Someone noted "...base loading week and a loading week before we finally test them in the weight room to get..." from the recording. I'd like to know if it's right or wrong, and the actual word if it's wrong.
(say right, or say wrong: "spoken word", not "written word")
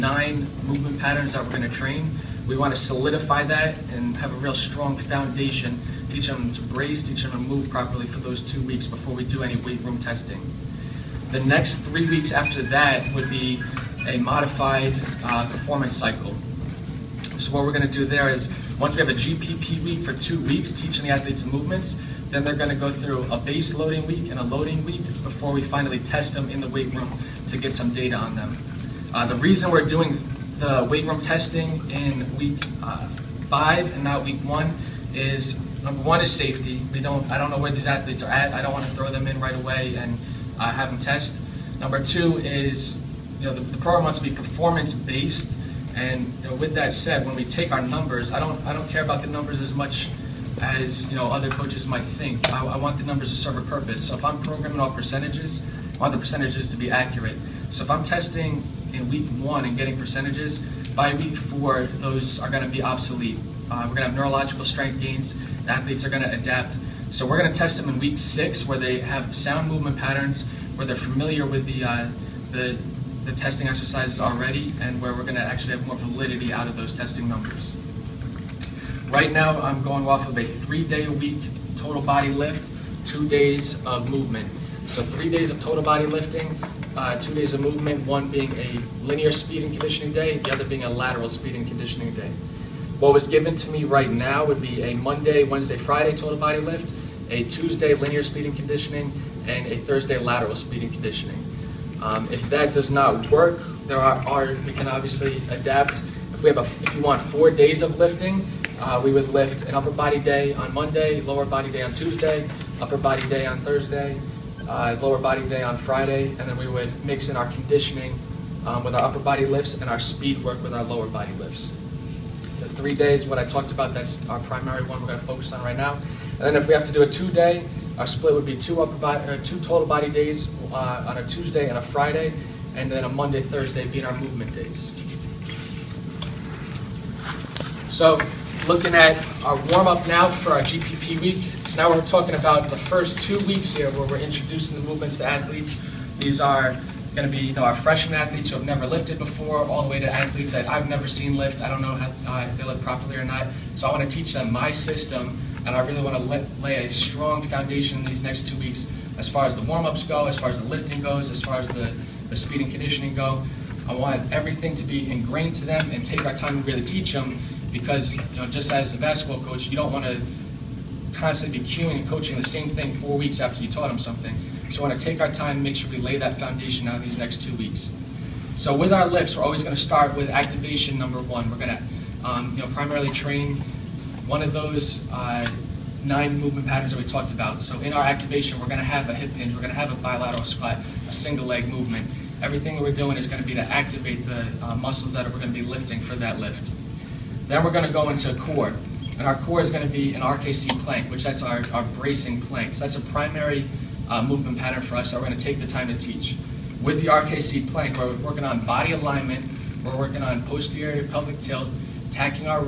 right.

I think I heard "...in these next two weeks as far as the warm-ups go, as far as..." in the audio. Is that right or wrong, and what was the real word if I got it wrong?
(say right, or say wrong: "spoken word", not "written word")
right.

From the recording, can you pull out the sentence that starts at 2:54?
So we want to take our time and make sure we lay that foundation out these next two weeks.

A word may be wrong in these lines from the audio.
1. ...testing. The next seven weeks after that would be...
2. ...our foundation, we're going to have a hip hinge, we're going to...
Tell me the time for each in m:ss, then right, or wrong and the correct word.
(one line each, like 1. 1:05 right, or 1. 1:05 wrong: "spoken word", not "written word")
1. 0:09 wrong: "three", not "seven"
2. 3:07 wrong: "activation", not "foundation".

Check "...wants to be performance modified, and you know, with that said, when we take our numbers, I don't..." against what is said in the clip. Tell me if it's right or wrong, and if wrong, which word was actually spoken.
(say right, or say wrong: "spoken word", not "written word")
wrong: "based", not "modified".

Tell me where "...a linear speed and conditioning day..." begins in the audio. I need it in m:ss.
1:28.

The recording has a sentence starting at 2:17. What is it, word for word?
So looking at our warm-up now for our GPP week.